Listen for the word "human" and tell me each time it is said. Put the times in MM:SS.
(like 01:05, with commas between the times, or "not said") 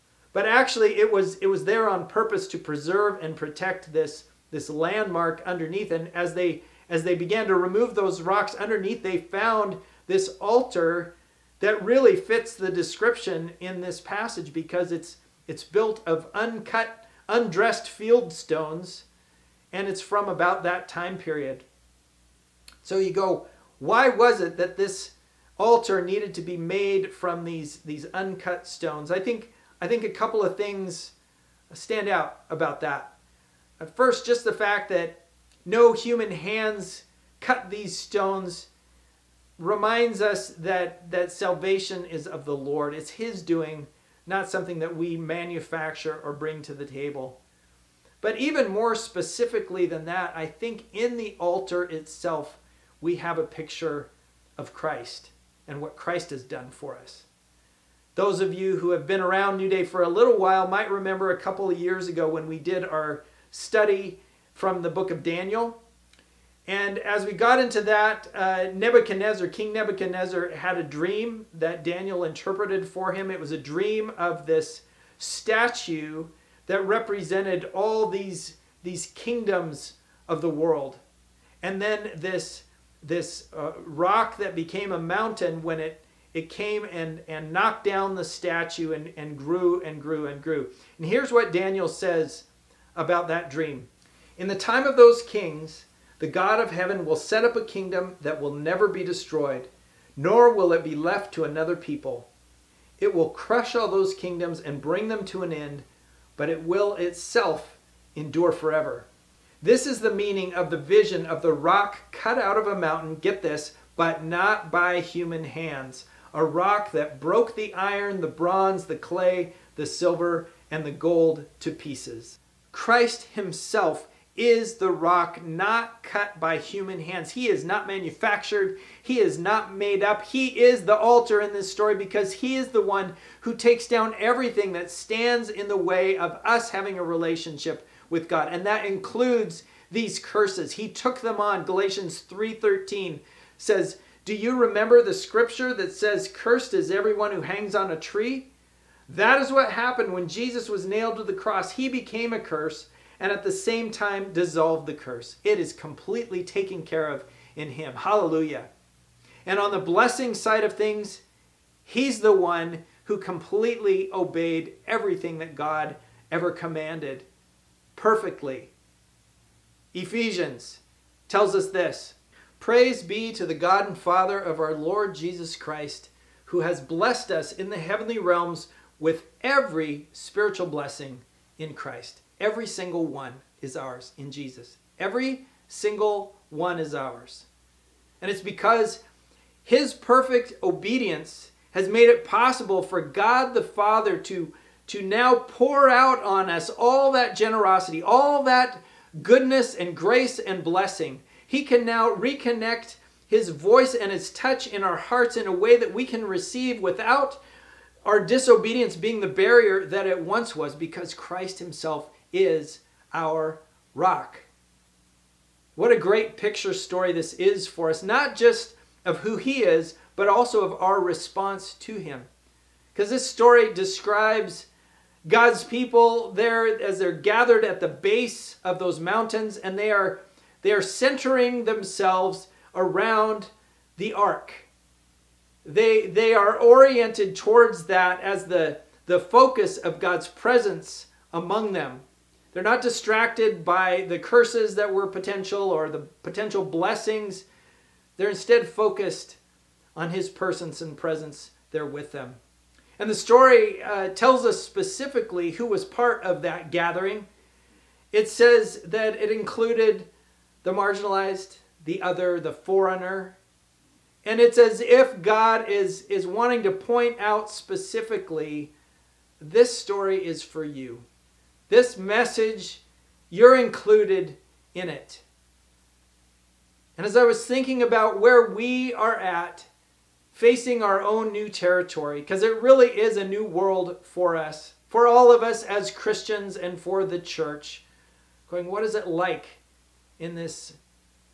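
00:35, 01:54, 02:06.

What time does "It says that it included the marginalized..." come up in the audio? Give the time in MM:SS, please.
04:18.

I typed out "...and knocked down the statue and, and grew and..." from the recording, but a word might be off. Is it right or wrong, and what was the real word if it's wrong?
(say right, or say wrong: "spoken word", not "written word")
right.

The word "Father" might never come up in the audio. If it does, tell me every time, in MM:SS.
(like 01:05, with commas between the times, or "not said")
02:53, 03:13.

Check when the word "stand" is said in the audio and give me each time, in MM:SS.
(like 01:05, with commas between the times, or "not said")
00:31, 02:14.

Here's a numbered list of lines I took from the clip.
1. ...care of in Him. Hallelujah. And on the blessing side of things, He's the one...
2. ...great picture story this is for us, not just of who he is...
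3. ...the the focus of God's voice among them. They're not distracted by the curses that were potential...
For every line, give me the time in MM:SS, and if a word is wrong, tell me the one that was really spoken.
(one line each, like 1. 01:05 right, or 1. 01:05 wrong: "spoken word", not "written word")
1. 02:36 right
2. 03:35 right
3. 03:58 wrong: "presence", not "voice".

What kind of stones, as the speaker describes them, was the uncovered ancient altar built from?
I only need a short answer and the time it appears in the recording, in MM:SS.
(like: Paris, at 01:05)
Uncut, undressed field stones, at 00:16.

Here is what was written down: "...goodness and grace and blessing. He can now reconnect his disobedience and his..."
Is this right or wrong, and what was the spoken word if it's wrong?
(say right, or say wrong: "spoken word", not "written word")
wrong: "voice", not "disobedience".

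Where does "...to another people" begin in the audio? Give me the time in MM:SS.
01:41.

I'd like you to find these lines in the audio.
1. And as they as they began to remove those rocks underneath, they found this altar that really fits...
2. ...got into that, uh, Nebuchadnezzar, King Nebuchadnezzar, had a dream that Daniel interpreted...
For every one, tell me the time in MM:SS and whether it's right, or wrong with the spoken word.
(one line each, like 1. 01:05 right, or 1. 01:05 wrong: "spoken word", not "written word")
1. 00:05 right
2. 01:07 right.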